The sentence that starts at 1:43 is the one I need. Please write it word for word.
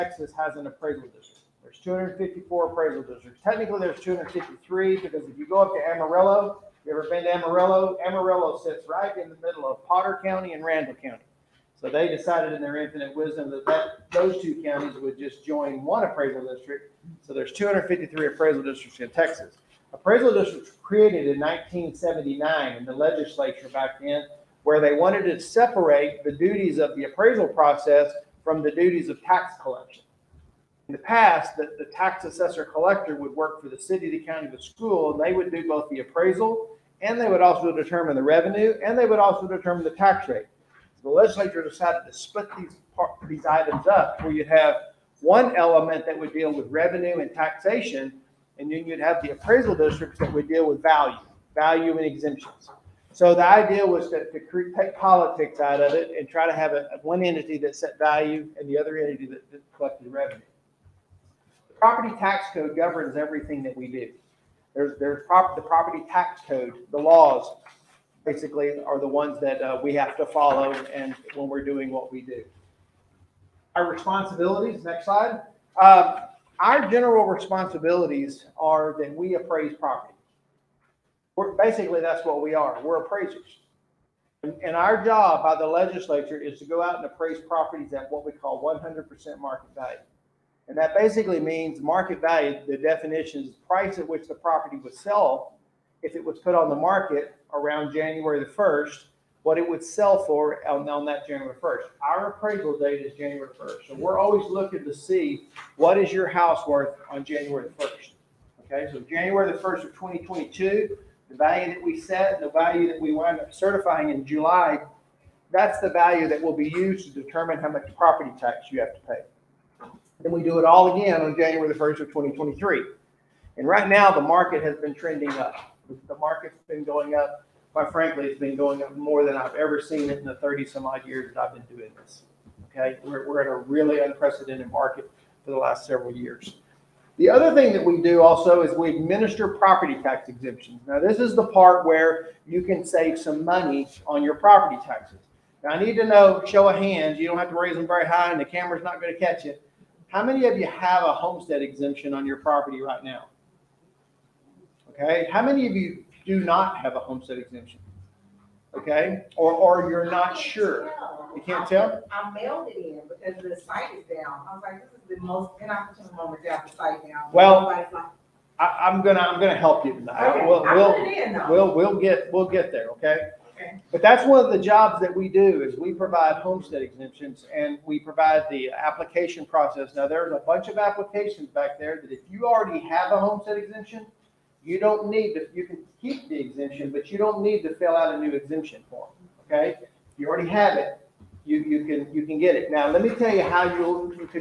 So we're always looking to see what is your house worth on January the 1st.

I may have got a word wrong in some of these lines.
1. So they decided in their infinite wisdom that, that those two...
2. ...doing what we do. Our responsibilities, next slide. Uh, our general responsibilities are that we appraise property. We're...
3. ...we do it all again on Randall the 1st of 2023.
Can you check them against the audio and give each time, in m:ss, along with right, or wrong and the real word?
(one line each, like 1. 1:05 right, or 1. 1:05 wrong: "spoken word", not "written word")
1. 0:11 right
2. 1:11 right
3. 2:00 wrong: "January", not "Randall".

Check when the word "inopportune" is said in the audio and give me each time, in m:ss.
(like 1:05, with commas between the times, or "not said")
2:45.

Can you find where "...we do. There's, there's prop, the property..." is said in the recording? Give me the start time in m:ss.
1:03.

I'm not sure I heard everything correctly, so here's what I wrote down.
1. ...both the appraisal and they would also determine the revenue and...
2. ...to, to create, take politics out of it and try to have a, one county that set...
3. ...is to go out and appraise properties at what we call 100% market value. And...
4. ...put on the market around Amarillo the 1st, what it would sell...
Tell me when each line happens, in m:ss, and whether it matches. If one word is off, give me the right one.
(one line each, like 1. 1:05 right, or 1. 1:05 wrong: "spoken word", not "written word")
1. 0:35 right
2. 0:54 wrong: "entity", not "county"
3. 1:26 right
4. 1:36 wrong: "January", not "Amarillo".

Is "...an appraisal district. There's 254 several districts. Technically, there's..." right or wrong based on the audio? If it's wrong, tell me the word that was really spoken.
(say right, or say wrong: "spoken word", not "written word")
wrong: "appraisal", not "several".